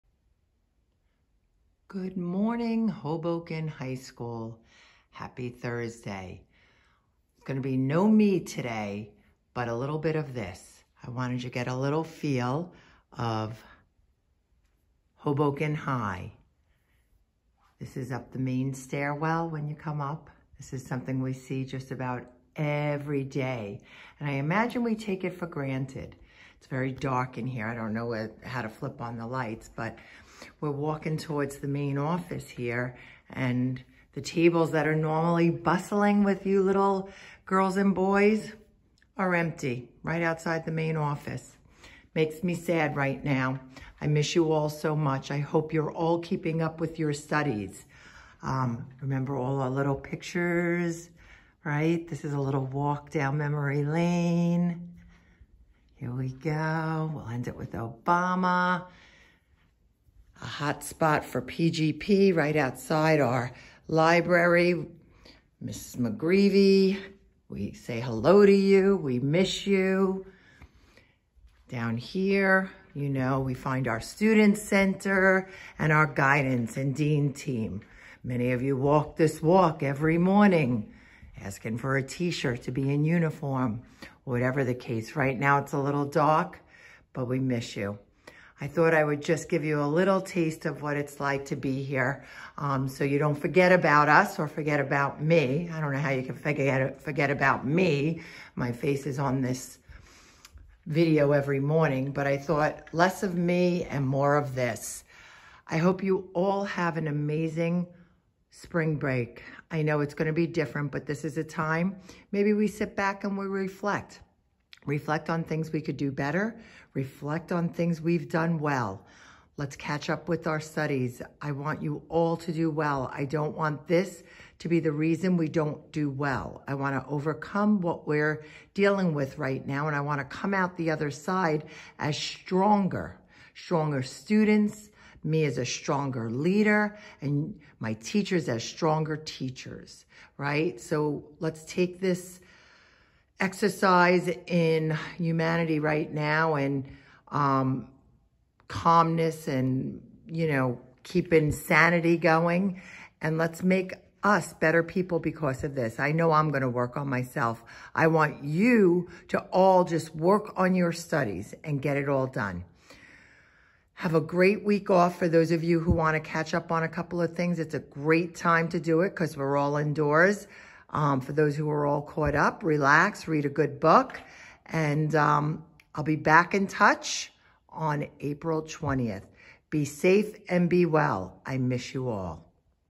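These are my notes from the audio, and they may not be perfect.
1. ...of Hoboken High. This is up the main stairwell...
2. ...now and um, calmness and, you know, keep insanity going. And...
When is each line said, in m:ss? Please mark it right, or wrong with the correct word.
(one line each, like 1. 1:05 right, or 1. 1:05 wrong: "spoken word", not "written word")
1. 0:13 right
2. 2:26 right.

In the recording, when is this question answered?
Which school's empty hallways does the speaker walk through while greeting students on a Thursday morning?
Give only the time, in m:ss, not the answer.
0:02.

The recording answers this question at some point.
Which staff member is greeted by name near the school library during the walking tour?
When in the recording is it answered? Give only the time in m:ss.
1:05.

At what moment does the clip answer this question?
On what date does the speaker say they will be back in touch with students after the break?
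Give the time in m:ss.
2:58.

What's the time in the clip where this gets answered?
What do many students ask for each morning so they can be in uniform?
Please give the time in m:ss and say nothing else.
1:22.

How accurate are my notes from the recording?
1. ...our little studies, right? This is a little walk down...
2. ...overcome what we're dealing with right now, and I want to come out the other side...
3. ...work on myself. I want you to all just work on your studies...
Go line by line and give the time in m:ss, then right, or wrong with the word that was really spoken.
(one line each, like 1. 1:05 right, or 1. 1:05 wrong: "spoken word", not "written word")
1. 0:49 wrong: "pictures", not "studies"
2. 2:07 right
3. 2:36 right.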